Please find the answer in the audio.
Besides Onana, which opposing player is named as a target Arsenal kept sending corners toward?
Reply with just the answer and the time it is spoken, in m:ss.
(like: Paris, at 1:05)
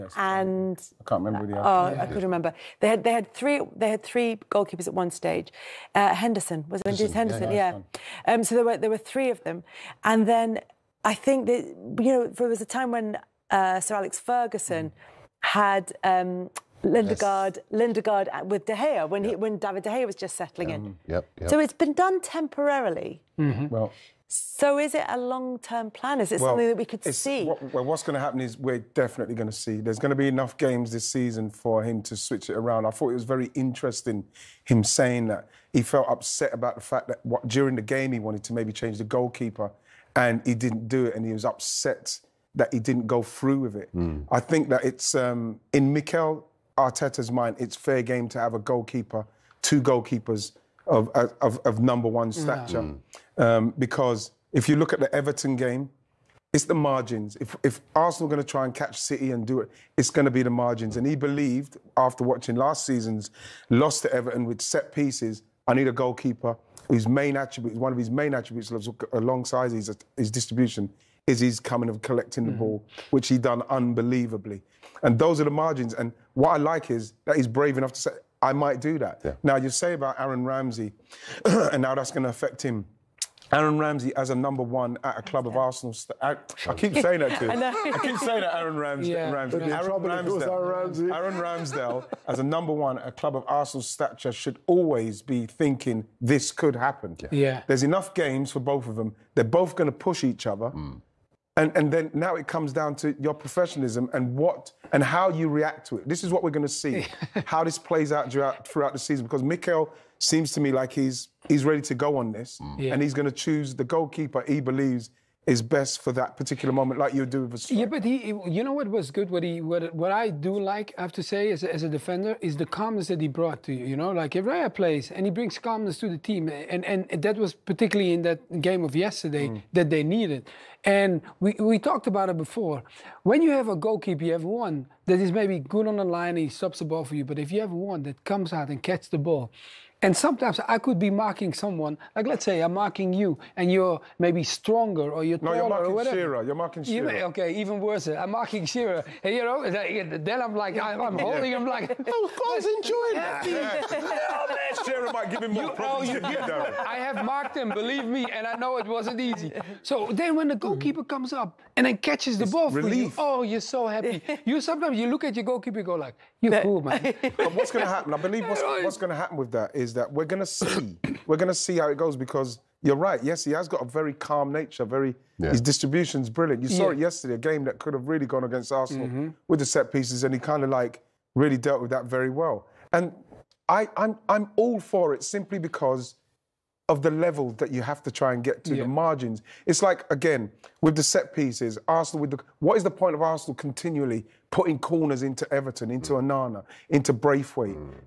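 Branthwaite, at 3:17.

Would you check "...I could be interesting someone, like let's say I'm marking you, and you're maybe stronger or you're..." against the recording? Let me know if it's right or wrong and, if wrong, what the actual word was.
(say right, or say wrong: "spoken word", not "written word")
wrong: "marking", not "interesting".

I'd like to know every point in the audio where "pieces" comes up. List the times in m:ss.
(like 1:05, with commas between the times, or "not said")
1:04, 2:59, 3:11.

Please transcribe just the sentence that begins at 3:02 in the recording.
And I, I'm, I'm all for it simply because of the level that you have to try and get to yeah.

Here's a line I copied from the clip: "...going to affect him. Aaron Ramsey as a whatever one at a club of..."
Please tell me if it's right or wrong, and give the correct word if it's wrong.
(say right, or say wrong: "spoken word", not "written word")
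wrong: "number", not "whatever".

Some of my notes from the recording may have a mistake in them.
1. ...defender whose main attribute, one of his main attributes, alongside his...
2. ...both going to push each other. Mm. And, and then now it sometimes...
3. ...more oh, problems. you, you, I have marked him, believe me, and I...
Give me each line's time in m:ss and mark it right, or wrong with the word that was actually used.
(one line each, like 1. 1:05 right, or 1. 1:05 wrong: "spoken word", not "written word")
1. 1:05 wrong: "goalkeeper", not "defender"
2. 1:39 wrong: "comes", not "sometimes"
3. 2:35 right.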